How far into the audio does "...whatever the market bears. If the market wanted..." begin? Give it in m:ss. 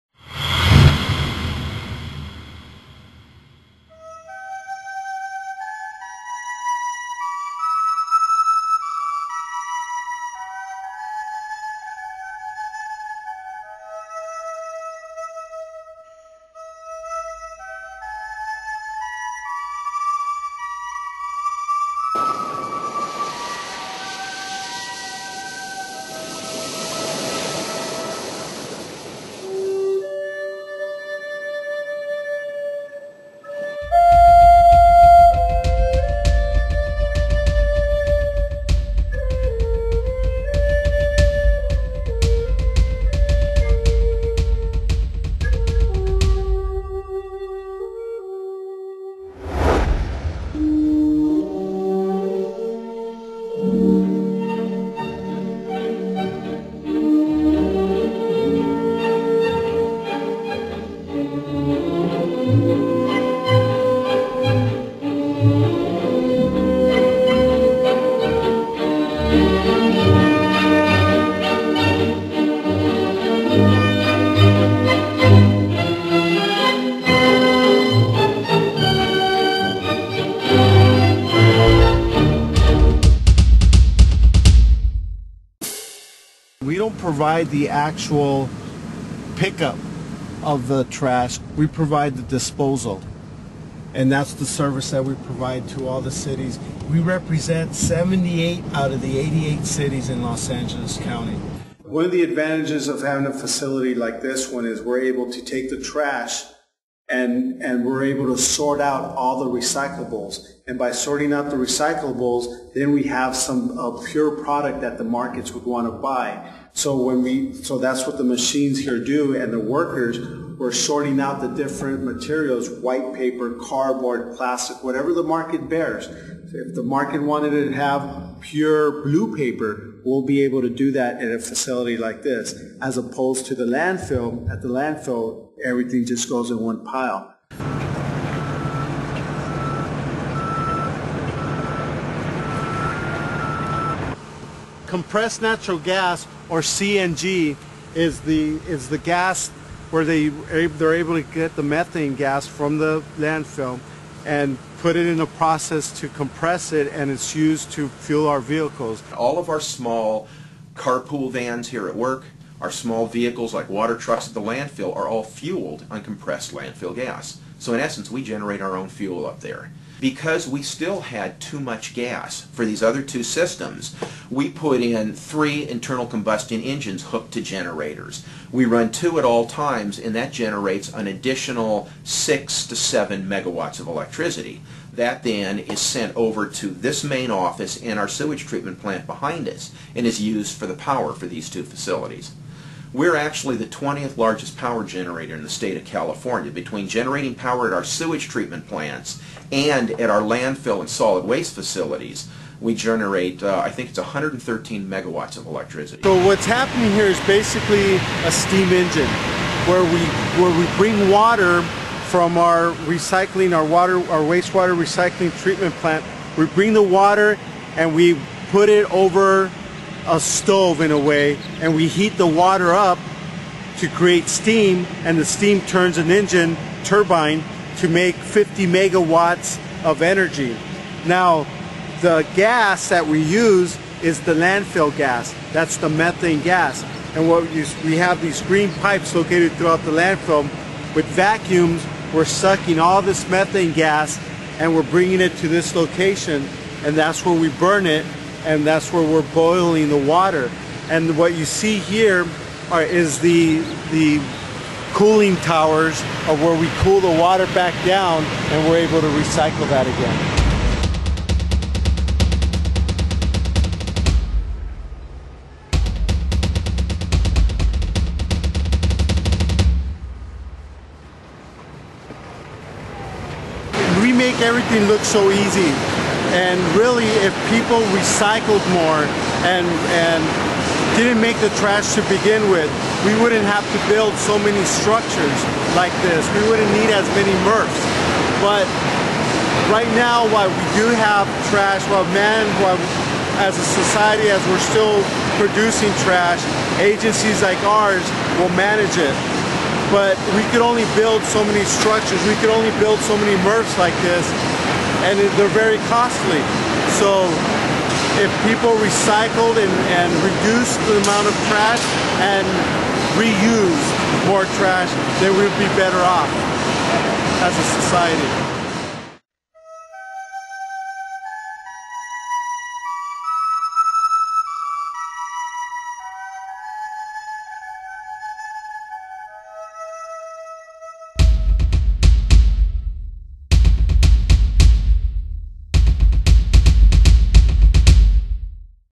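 2:04.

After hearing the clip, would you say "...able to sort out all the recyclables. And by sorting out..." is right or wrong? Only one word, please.
right.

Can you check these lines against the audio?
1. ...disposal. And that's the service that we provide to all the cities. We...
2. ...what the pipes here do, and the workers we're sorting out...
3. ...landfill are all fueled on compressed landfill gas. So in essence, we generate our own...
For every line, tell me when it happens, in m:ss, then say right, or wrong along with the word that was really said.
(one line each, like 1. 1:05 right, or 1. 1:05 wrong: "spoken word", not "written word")
1. 1:32 right
2. 1:58 wrong: "machines", not "pipes"
3. 2:44 right.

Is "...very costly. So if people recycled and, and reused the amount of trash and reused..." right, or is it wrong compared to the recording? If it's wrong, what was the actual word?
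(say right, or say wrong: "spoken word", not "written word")
wrong: "reduced", not "reused".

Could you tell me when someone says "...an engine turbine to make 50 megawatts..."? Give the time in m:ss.
3:45.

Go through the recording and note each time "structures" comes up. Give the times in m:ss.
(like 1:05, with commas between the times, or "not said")
4:44, 5:01.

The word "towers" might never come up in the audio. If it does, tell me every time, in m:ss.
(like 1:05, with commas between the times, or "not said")
4:15.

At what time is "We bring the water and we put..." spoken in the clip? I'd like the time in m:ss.
3:36.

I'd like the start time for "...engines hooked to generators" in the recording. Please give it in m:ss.
2:56.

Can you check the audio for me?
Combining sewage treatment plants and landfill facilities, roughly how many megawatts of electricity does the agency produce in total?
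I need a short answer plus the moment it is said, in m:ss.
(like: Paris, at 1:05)
113 megawatts, at 3:23.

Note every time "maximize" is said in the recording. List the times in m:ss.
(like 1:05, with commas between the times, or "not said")
not said.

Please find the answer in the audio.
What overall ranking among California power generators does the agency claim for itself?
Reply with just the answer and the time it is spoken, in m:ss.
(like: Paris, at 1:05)
20th largest, at 3:13.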